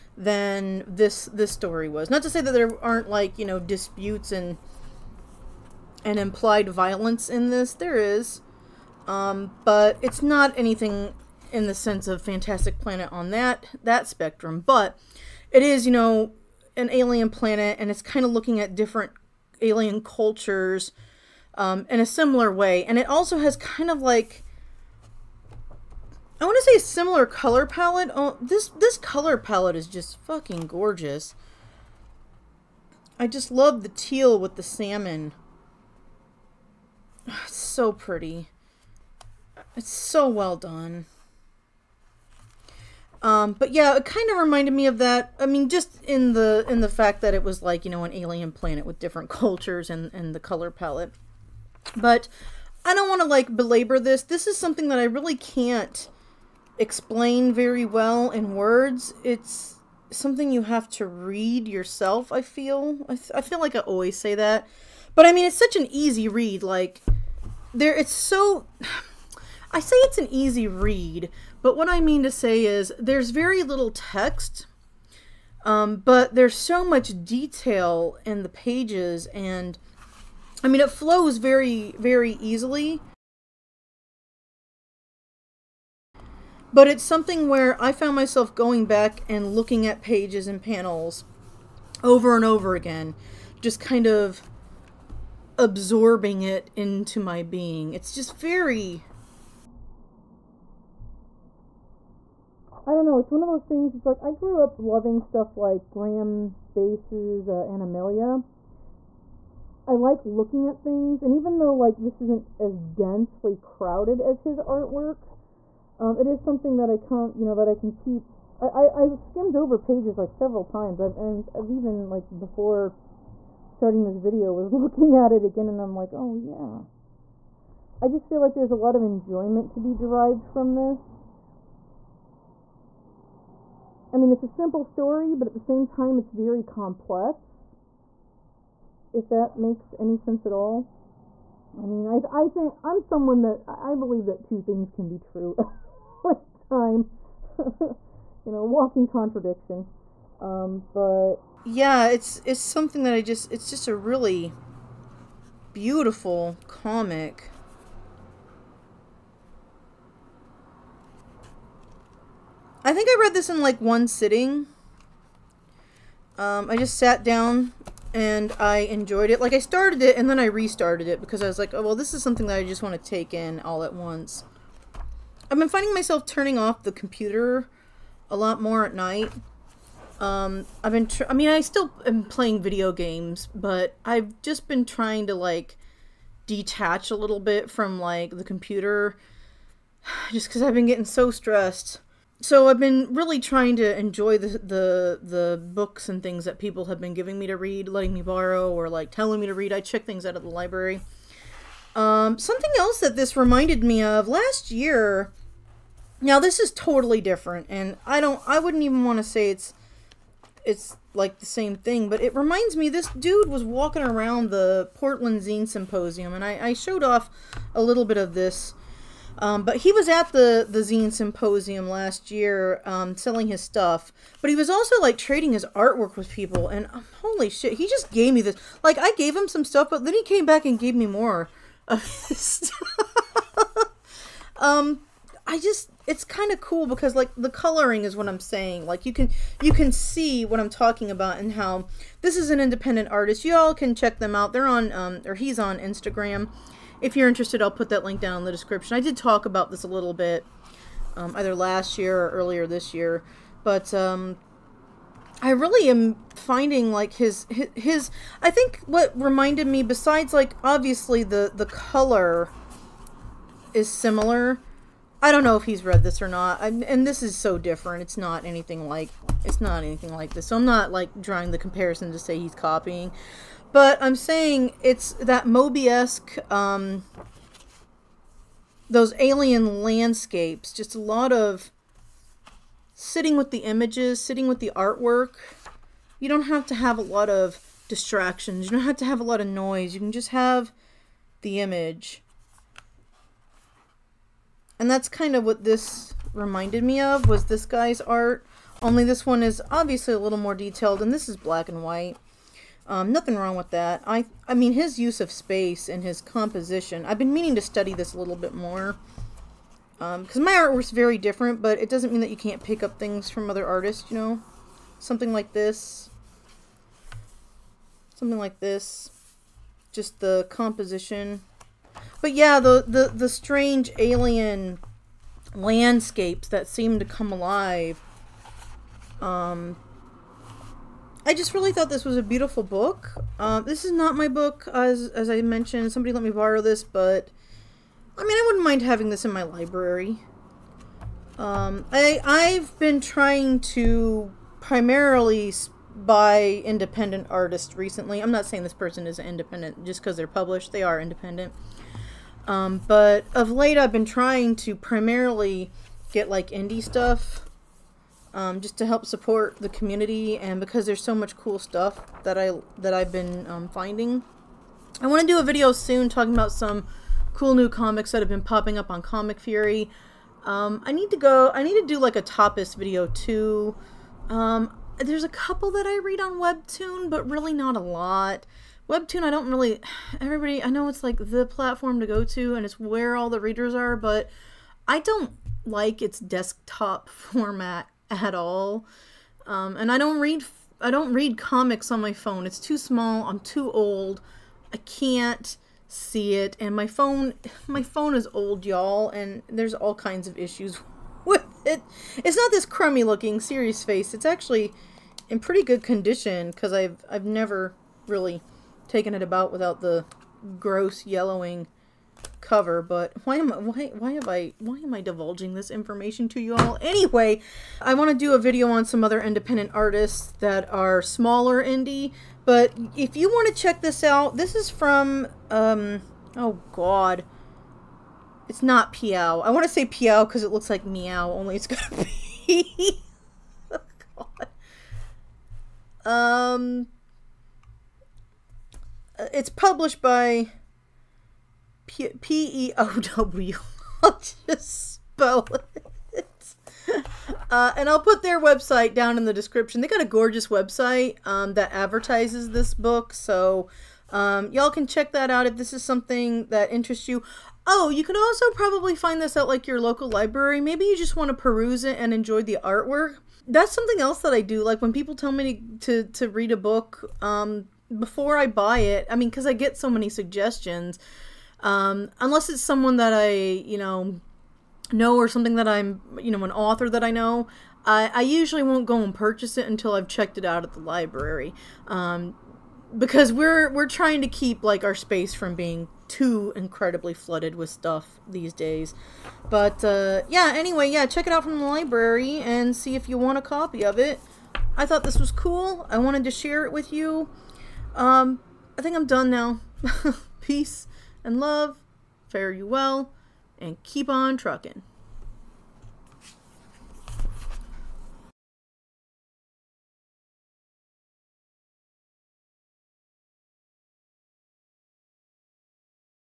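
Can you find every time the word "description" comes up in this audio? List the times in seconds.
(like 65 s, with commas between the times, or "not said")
248 s, 449 s.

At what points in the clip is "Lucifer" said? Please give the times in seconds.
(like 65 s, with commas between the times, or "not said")
not said.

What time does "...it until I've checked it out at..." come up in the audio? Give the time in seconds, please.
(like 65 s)
479 s.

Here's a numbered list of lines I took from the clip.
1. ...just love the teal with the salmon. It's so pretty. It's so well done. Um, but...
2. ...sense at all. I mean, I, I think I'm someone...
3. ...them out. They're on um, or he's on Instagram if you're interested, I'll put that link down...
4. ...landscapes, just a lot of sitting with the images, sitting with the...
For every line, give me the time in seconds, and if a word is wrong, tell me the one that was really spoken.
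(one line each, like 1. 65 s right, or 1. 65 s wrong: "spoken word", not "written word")
1. 33 s right
2. 140 s right
3. 244 s right
4. 279 s right.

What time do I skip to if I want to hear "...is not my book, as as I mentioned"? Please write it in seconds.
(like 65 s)
333 s.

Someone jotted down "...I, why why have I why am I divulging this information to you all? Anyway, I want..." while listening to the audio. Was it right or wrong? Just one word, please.
right.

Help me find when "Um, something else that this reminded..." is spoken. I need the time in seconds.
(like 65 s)
201 s.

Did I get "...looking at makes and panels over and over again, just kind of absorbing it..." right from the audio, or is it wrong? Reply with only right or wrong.
wrong.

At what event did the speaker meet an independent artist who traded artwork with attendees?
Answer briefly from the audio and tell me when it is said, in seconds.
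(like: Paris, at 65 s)
Portland Zine Symposium, at 214 s.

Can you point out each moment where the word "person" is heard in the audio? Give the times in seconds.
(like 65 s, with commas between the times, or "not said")
348 s.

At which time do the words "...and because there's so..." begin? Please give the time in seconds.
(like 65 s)
360 s.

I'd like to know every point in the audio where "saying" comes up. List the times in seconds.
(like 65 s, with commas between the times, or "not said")
238 s, 274 s, 348 s.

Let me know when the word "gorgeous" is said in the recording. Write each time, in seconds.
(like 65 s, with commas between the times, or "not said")
30 s, 450 s.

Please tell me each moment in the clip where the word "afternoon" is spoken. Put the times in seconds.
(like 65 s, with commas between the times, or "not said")
not said.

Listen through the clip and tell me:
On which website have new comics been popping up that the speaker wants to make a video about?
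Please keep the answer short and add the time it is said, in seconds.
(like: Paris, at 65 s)
Comic Fury, at 369 s.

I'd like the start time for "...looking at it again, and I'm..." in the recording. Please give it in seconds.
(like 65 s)
124 s.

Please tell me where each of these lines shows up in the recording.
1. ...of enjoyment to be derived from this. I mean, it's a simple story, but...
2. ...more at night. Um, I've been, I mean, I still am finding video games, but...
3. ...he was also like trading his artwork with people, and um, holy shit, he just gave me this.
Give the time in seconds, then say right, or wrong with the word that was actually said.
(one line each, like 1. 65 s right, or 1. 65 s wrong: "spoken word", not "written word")
1. 128 s right
2. 178 s wrong: "playing", not "finding"
3. 224 s right.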